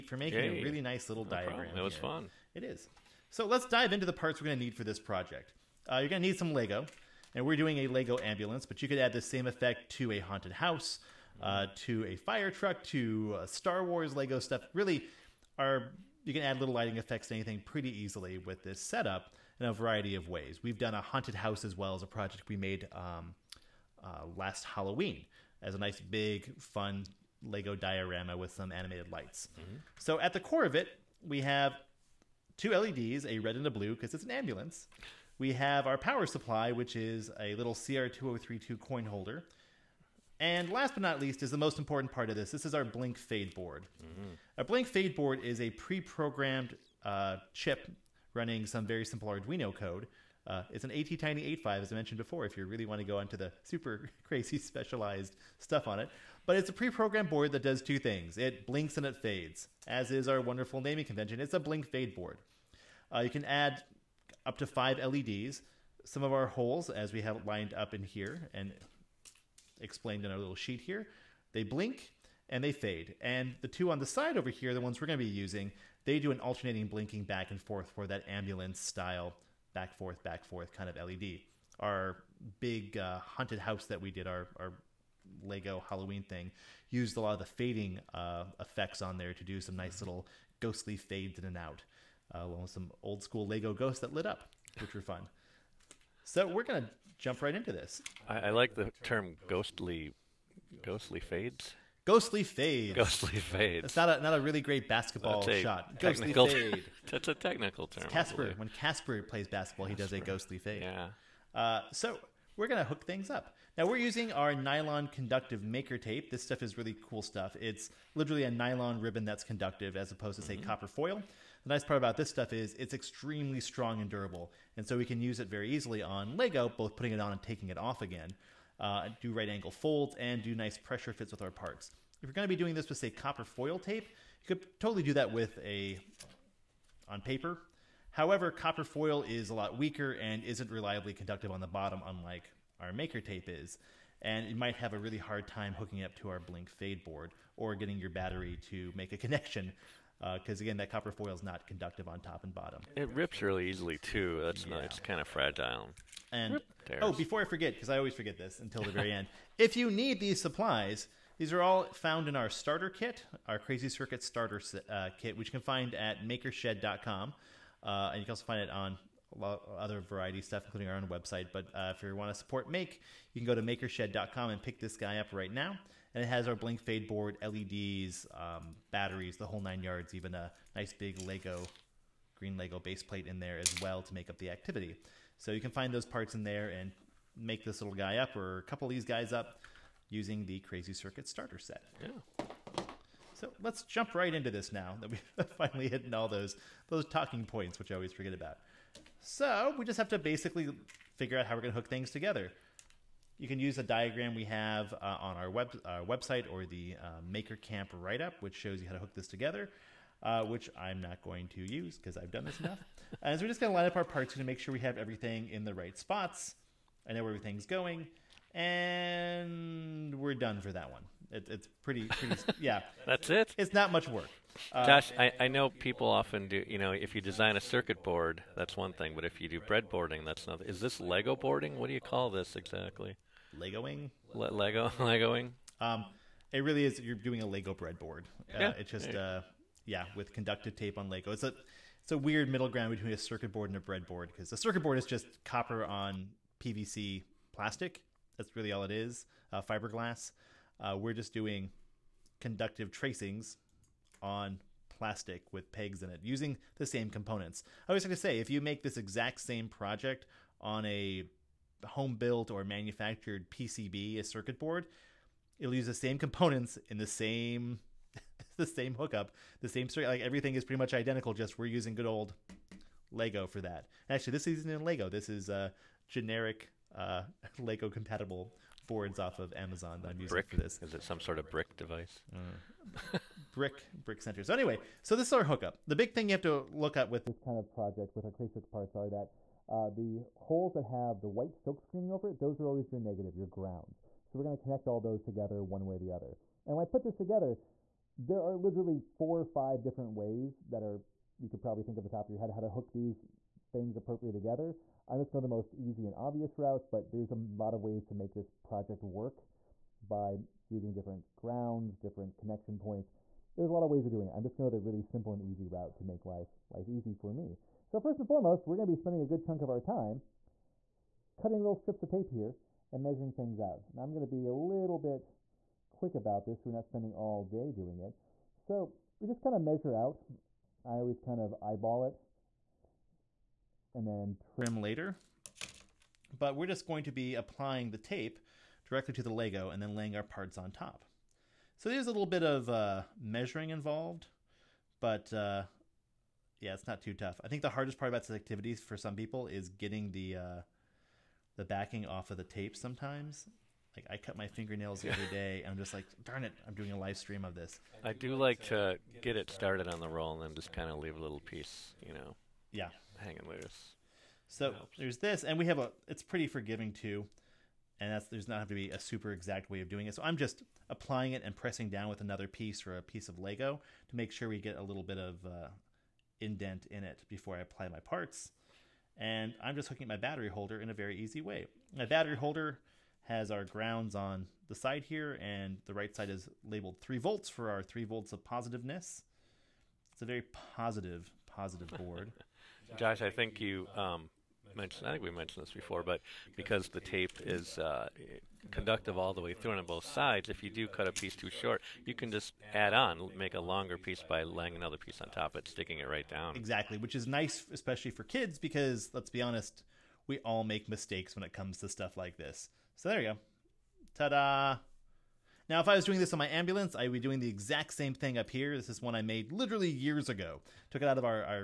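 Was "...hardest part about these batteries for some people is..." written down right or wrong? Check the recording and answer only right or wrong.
wrong.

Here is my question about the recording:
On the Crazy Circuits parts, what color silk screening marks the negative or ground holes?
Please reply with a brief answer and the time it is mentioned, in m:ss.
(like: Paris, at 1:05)
White, at 4:51.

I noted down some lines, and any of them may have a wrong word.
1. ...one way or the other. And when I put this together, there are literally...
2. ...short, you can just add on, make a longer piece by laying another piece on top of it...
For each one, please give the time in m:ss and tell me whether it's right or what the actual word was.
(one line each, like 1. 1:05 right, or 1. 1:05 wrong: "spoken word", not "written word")
1. 4:55 right
2. 6:41 right.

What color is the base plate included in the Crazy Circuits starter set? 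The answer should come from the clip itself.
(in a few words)
Green.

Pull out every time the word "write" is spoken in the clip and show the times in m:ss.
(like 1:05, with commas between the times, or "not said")
3:27.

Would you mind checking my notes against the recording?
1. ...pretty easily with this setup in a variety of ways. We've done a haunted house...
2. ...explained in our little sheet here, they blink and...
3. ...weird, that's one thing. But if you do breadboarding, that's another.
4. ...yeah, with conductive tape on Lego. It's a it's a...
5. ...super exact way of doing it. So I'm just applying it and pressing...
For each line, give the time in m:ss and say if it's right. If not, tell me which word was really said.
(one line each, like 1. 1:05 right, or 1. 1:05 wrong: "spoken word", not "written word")
1. 0:17 right
2. 1:09 right
3. 3:48 wrong: "board", not "weird"
4. 3:59 right
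5. 6:08 right.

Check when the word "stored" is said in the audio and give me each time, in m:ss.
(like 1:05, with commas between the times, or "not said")
not said.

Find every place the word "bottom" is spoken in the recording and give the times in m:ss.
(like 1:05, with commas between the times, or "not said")
2:21, 2:32.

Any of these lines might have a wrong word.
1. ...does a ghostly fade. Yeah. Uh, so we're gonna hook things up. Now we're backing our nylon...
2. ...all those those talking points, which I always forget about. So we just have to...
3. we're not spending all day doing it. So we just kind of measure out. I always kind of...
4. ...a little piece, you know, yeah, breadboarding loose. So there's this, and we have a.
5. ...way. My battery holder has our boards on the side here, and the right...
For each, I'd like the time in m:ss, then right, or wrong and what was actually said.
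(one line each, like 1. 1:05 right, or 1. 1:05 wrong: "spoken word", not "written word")
1. 1:50 wrong: "using", not "backing"
2. 3:16 right
3. 5:26 right
4. 6:01 wrong: "hanging", not "breadboarding"
5. 6:21 wrong: "grounds", not "boards".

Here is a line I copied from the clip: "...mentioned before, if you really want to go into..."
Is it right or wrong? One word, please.
right.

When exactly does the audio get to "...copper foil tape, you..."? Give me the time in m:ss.
2:13.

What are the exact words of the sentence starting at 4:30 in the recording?
Like everything is pretty much identical.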